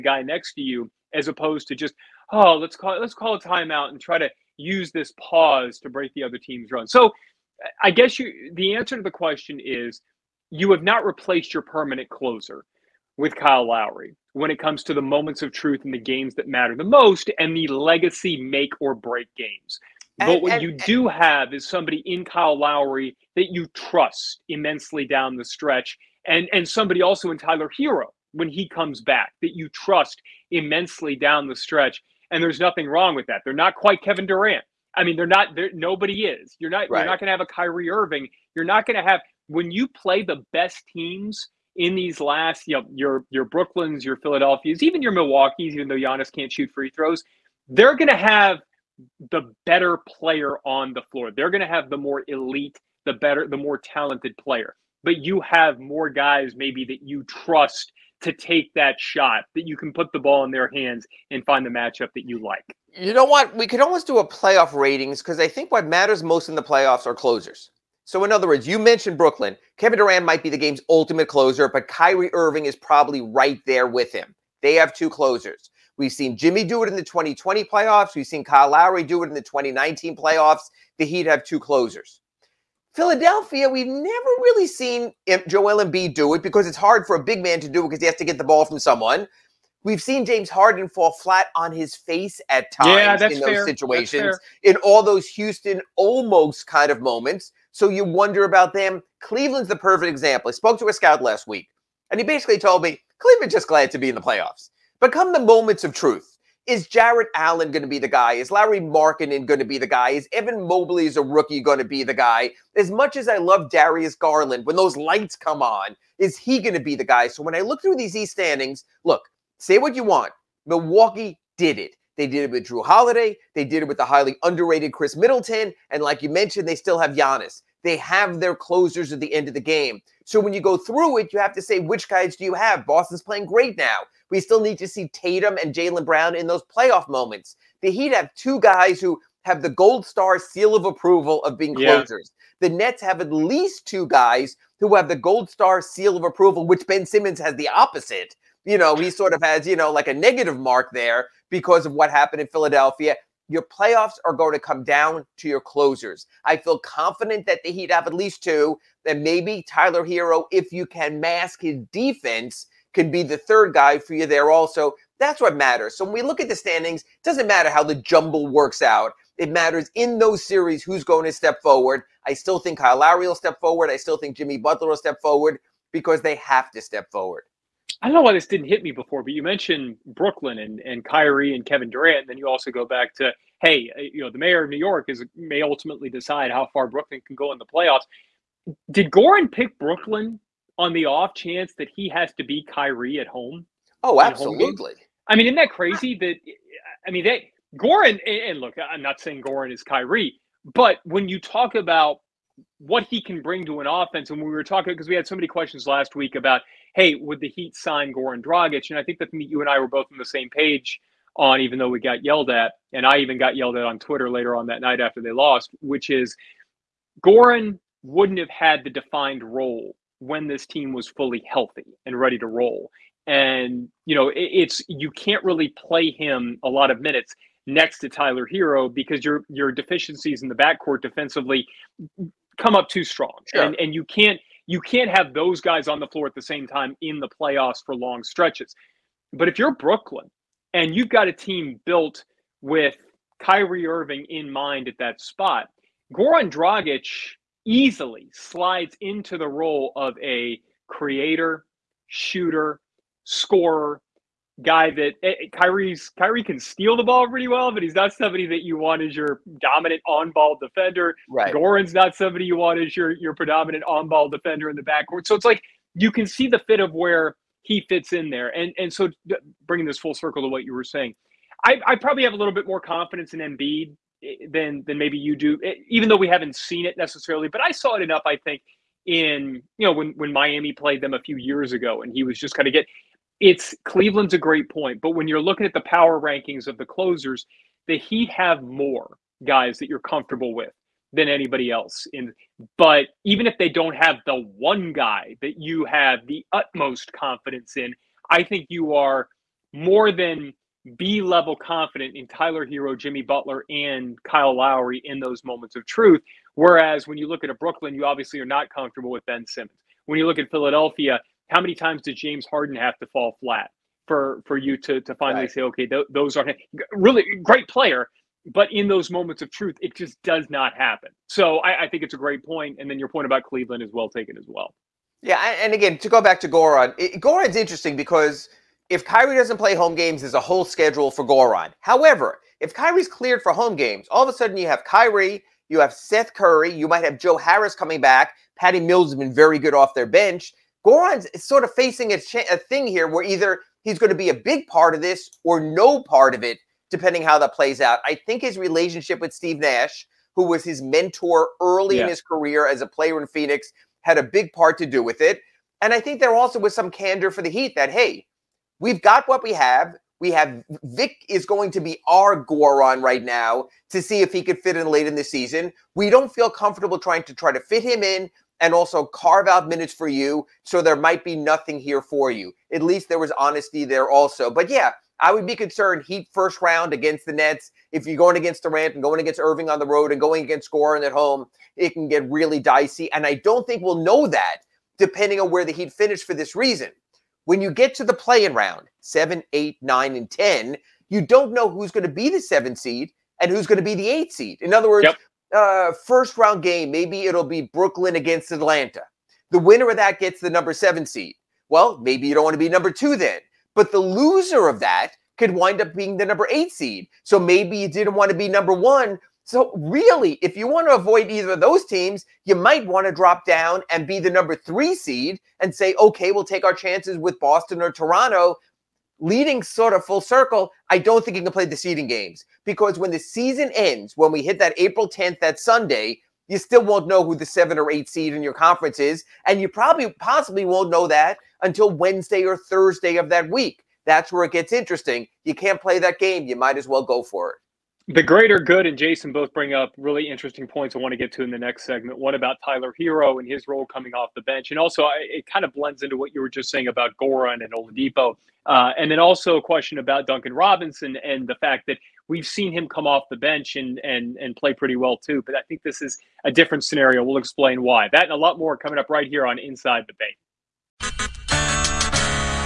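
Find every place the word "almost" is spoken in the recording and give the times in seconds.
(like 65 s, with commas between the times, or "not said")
63 s, 95 s.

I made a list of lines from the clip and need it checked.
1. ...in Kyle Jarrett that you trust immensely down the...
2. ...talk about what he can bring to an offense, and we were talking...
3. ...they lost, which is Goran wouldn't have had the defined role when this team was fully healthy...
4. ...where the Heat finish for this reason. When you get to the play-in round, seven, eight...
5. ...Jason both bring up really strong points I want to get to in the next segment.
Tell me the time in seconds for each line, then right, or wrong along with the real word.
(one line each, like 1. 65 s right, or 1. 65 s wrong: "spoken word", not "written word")
1. 22 s wrong: "Lowry", not "Jarrett"
2. 201 s right
3. 215 s right
4. 385 s right
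5. 438 s wrong: "interesting", not "strong".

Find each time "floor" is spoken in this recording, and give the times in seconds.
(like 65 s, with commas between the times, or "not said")
51 s, 236 s.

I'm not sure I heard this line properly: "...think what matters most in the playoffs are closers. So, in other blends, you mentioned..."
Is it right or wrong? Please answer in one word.
wrong.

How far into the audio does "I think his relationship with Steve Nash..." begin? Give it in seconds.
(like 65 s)
348 s.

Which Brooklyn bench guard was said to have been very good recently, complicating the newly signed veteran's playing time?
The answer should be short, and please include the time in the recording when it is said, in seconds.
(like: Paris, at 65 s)
Patty Mills, at 338 s.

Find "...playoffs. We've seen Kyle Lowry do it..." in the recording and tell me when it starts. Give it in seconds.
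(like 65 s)
77 s.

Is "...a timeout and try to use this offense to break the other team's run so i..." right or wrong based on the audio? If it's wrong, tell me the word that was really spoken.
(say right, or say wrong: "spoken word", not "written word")
wrong: "pause", not "offense".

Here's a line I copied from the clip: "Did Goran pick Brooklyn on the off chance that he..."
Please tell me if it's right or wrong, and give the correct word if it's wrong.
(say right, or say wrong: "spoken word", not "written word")
right.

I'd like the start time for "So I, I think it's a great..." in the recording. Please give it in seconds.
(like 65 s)
321 s.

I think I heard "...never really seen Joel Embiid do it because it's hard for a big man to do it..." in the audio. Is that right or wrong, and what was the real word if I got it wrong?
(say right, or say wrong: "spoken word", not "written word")
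right.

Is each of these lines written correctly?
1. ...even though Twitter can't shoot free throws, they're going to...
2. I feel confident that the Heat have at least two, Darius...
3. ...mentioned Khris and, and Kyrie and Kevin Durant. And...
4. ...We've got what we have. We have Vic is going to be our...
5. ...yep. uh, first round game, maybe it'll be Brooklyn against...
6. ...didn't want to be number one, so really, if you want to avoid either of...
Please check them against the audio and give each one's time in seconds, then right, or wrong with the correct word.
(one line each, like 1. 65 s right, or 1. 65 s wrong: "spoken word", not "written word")
1. 45 s wrong: "Giannis", not "Twitter"
2. 156 s wrong: "Then", not "Darius"
3. 179 s wrong: "Brooklyn", not "Khris"
4. 358 s right
5. 395 s right
6. 407 s right.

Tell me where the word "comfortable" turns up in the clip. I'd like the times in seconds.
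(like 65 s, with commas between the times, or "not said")
289 s, 308 s, 366 s.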